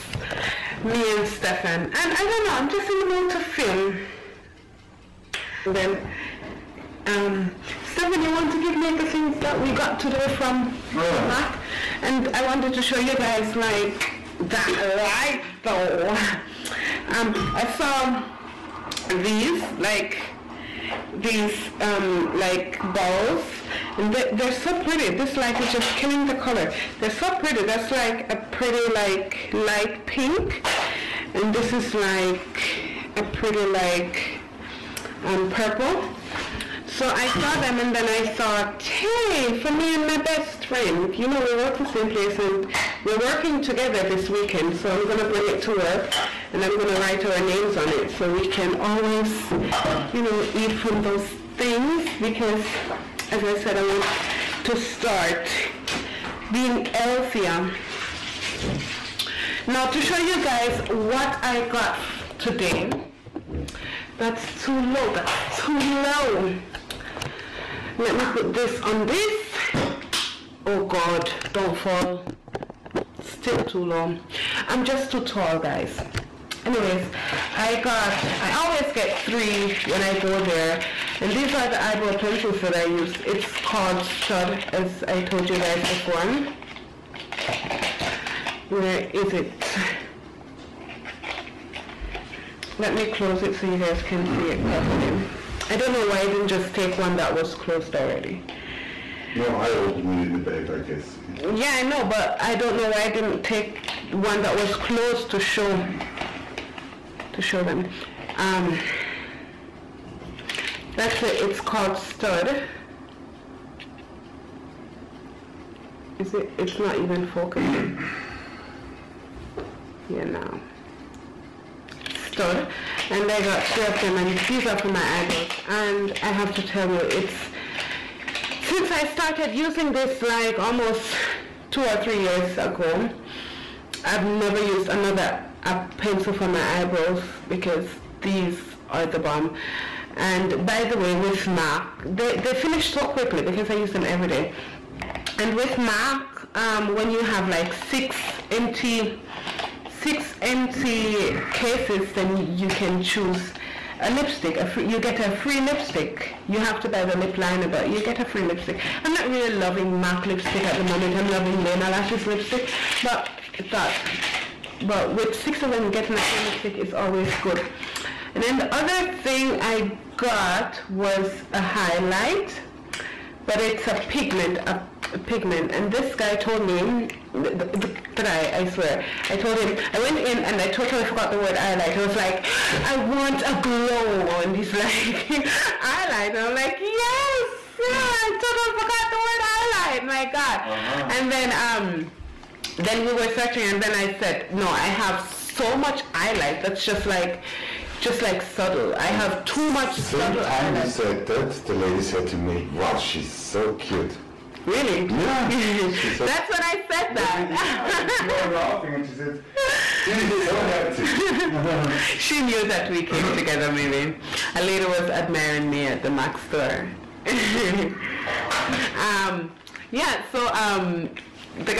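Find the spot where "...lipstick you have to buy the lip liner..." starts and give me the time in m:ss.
2:35.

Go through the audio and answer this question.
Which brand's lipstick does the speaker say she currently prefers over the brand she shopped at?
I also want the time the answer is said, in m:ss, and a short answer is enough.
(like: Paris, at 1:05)
Lena Lashes, at 2:41.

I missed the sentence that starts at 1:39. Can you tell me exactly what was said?
No, I opened it in the bag, I guess.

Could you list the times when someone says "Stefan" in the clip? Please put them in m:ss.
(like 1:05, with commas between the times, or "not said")
0:01.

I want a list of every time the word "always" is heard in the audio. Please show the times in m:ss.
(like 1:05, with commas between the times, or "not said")
0:48, 1:18, 2:46.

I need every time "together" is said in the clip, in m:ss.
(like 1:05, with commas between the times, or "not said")
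0:43, 3:33.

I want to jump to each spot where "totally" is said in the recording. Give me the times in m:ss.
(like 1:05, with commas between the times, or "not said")
3:00, 3:08.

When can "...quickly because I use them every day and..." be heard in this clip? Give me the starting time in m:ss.
2:23.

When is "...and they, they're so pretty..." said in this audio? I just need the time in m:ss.
0:23.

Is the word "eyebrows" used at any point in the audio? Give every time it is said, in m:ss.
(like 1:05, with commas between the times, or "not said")
1:21, 2:05, 2:16.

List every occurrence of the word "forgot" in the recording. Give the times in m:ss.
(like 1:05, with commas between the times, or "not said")
3:01, 3:08.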